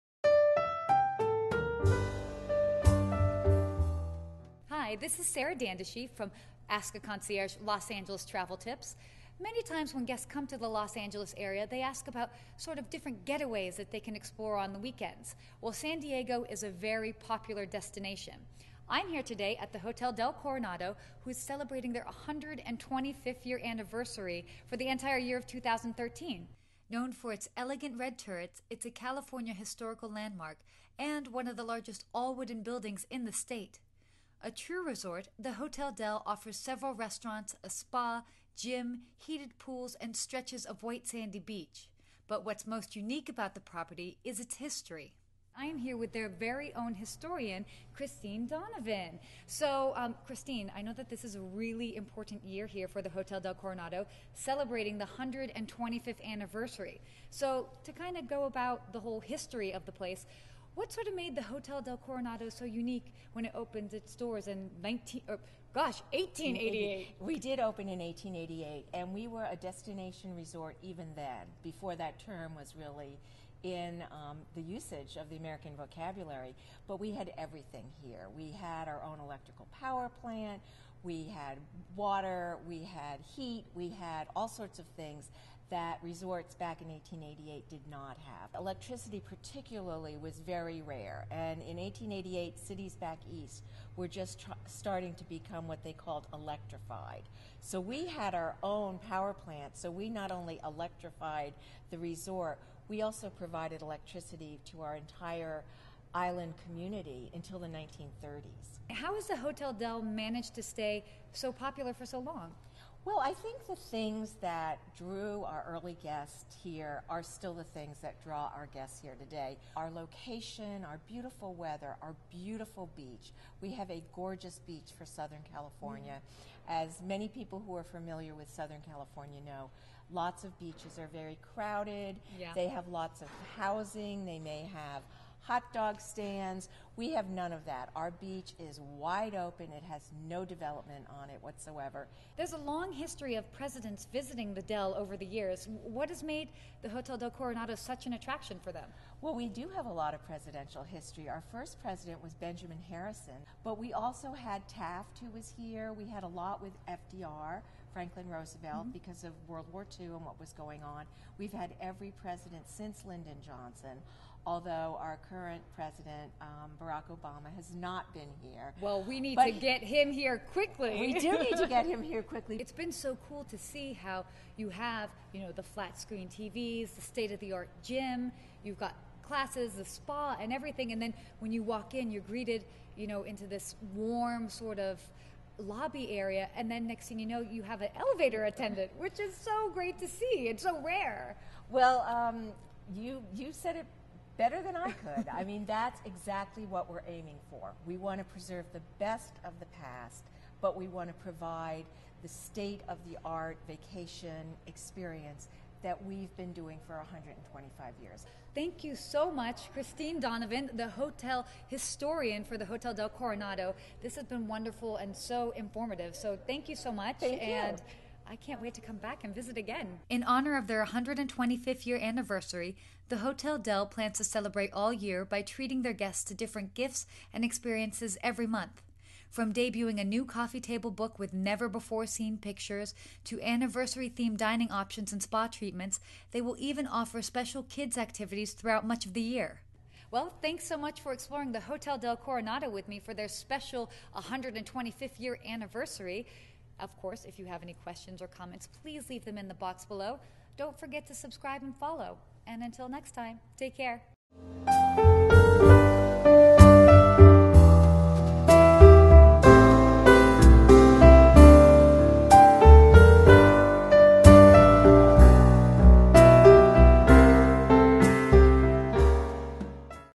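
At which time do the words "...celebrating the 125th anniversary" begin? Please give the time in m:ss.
0:54.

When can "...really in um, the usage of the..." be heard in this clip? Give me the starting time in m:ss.
1:12.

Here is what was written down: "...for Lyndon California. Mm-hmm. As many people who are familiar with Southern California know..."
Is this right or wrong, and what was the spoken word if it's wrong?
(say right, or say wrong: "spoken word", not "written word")
wrong: "Southern", not "Lyndon".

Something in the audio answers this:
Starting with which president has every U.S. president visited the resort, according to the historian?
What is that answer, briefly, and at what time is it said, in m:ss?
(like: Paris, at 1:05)
Lyndon Johnson, at 2:43.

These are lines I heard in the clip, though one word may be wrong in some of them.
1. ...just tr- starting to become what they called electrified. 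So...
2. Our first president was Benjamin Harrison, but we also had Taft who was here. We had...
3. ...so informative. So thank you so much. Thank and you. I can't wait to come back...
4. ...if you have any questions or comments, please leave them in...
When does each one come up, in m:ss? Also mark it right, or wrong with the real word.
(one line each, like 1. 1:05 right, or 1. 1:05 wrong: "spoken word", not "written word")
1. 1:34 right
2. 2:31 right
3. 3:35 right
4. 4:07 right.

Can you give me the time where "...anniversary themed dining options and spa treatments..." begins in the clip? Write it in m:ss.
3:53.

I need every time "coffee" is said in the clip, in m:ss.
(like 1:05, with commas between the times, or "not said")
3:50.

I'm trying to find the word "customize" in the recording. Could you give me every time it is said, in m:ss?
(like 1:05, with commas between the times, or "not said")
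not said.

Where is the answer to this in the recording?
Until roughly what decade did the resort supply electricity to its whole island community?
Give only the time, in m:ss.
1:47.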